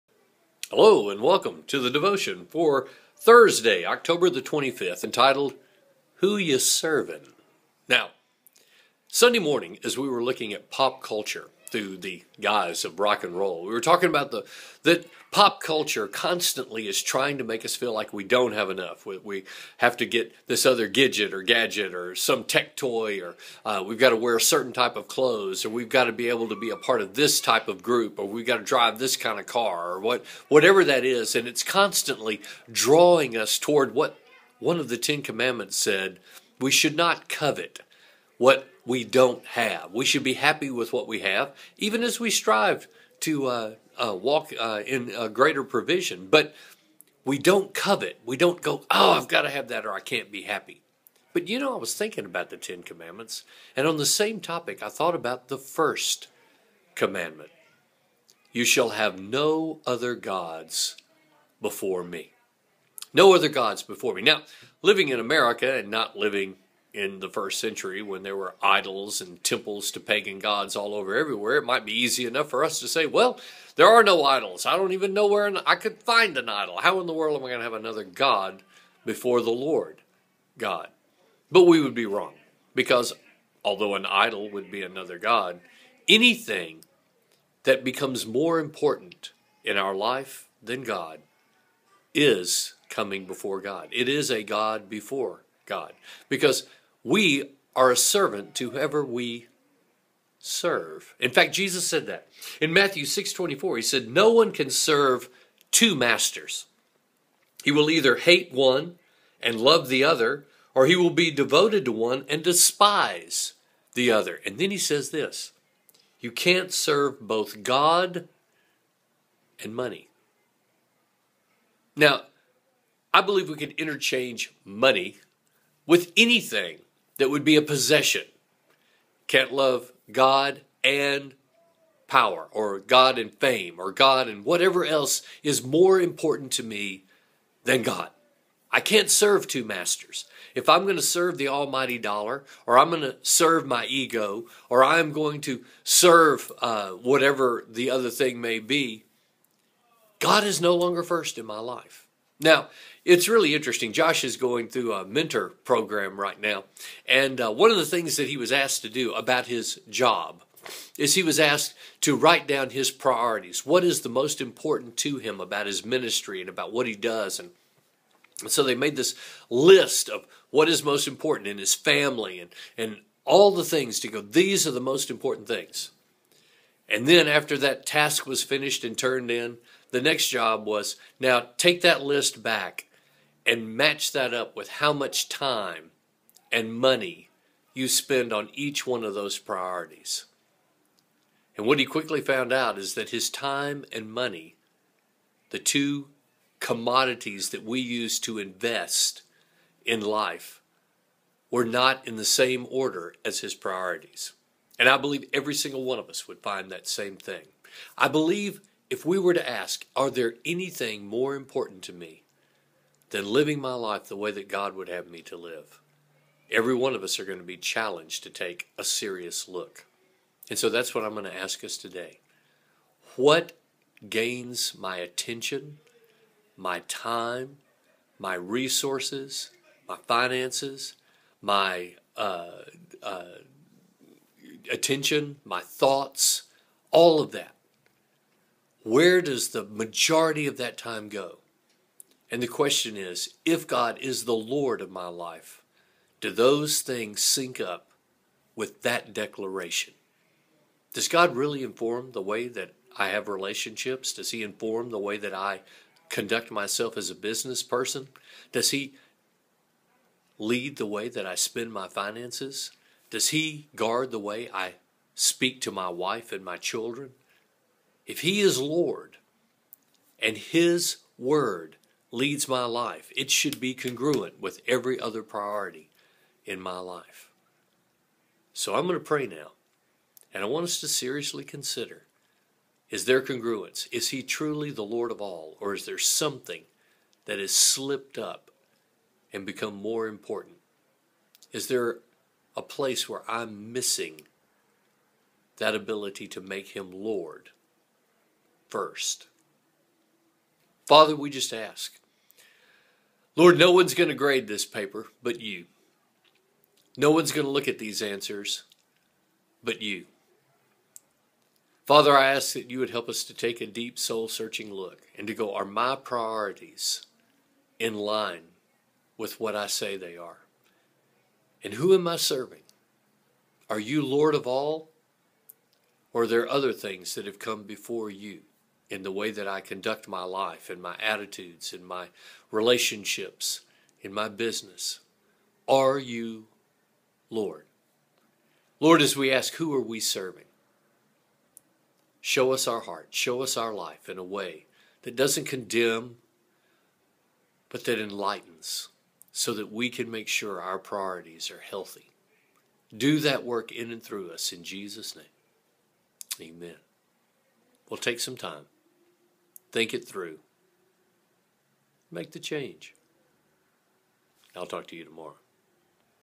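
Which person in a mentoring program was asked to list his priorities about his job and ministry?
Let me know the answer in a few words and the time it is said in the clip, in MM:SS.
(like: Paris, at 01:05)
Josh, at 02:33.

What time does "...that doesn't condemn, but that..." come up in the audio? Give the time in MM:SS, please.
05:45.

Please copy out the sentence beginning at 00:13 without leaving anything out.
We were talking about the that pop culture constantly is trying to make us feel like we don't have enough.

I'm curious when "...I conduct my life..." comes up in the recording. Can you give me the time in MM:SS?
05:29.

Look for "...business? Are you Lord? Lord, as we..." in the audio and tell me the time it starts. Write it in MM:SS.
05:34.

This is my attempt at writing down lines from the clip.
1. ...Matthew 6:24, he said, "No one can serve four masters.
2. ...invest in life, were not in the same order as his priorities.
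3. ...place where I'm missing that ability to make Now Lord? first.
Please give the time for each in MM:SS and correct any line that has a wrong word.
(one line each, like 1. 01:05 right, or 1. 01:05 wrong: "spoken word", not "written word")
1. 01:42 wrong: "two", not "four"
2. 03:18 right
3. 04:52 wrong: "Him", not "Now".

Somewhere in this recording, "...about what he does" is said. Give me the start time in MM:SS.
02:46.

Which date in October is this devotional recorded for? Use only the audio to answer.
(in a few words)
25th.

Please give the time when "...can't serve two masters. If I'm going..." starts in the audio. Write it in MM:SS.
02:18.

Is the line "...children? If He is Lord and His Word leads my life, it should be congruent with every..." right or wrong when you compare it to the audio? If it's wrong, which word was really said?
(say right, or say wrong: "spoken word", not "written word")
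right.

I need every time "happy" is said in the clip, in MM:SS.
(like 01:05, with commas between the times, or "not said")
00:40, 00:50.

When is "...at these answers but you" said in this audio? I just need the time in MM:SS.
05:07.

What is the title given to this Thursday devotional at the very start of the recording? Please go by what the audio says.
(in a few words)
Who You Servin'.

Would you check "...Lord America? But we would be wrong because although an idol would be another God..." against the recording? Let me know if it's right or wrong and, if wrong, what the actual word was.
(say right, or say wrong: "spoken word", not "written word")
wrong: "God", not "America".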